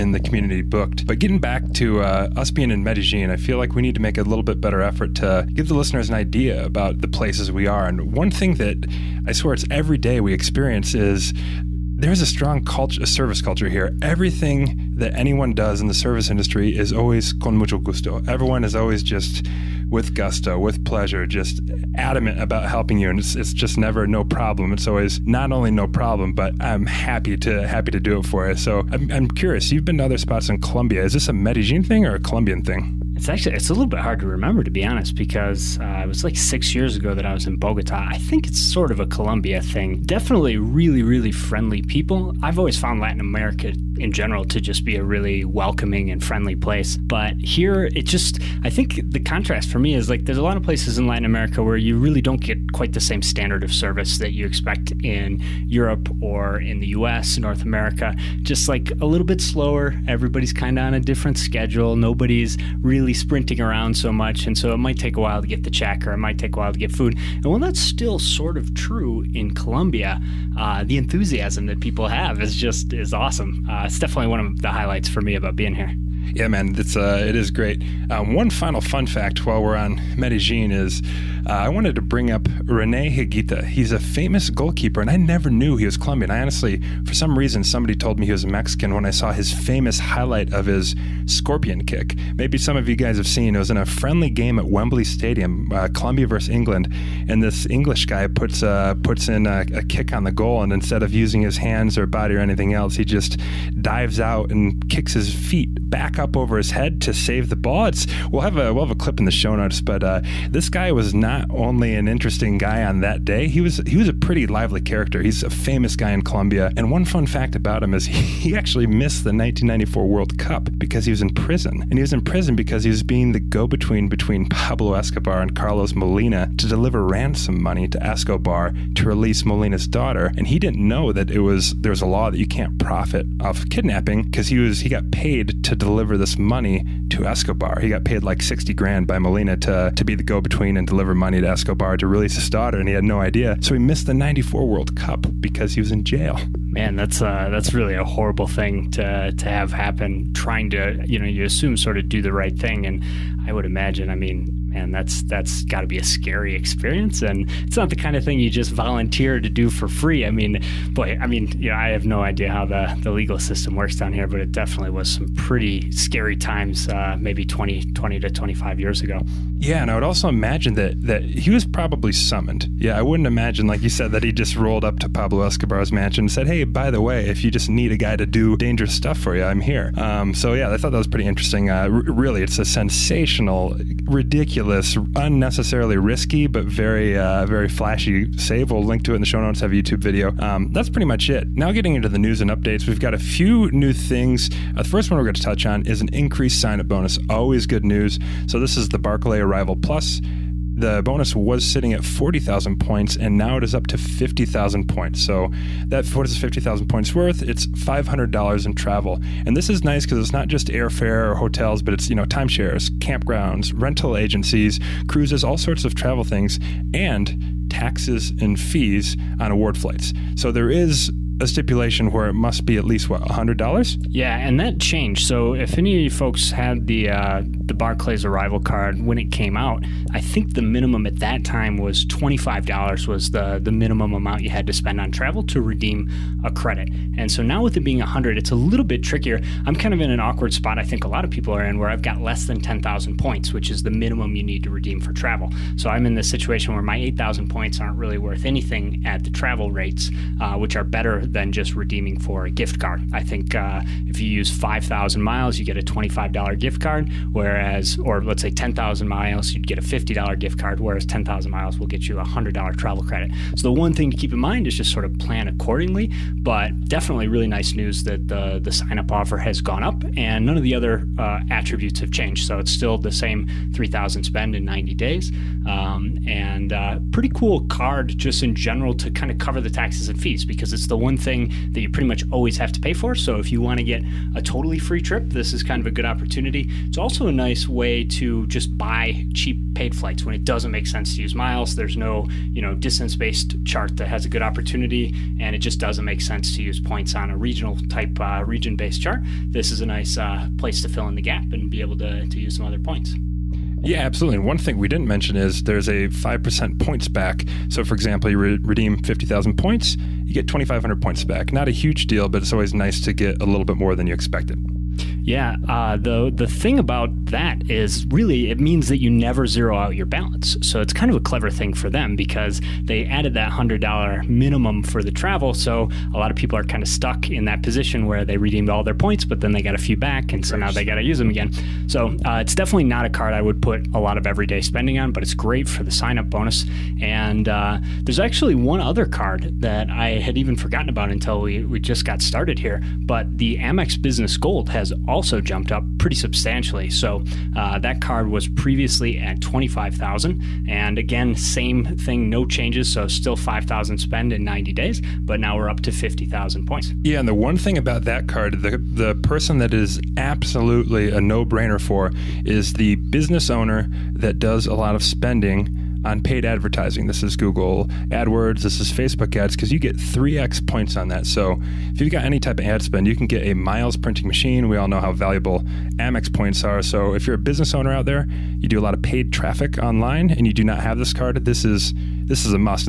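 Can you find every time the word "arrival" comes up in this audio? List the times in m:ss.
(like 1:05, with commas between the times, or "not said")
3:19, 3:48.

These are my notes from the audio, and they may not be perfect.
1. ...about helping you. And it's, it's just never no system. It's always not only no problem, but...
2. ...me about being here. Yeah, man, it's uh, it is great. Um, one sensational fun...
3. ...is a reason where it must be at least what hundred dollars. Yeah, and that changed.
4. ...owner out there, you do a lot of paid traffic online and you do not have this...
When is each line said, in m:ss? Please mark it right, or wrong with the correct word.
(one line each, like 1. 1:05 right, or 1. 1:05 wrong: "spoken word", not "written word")
1. 0:22 wrong: "problem", not "system"
2. 1:15 wrong: "final", not "sensational"
3. 3:40 wrong: "stipulation", not "reason"
4. 6:17 right.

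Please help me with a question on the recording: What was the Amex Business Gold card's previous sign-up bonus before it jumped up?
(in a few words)
25,000.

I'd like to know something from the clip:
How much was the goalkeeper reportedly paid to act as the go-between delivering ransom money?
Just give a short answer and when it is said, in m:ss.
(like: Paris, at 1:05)
60 grand, at 2:18.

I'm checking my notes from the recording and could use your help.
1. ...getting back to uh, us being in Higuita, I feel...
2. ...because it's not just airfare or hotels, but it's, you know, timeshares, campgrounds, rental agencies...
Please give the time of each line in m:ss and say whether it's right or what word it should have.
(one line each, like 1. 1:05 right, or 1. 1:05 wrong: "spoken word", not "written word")
1. 0:01 wrong: "Medellin", not "Higuita"
2. 3:30 right.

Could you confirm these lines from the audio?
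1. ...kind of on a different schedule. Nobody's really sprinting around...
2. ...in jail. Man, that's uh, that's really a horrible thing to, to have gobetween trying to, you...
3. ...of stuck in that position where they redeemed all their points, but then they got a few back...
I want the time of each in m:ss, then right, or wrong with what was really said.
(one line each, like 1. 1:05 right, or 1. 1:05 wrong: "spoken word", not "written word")
1. 1:00 right
2. 2:25 wrong: "happen", not "gobetween"
3. 5:26 right.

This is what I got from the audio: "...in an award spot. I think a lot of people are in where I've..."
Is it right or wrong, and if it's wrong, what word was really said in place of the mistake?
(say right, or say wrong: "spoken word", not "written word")
wrong: "awkward", not "award".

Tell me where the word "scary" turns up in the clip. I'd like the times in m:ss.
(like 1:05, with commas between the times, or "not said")
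2:36, 2:45.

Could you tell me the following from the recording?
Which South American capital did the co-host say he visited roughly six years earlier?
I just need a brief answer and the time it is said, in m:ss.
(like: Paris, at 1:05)
Bogota, at 0:37.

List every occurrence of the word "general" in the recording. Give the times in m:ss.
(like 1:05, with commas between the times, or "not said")
0:44, 4:38.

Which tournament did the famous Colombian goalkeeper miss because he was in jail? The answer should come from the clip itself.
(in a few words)
1994 World Cup.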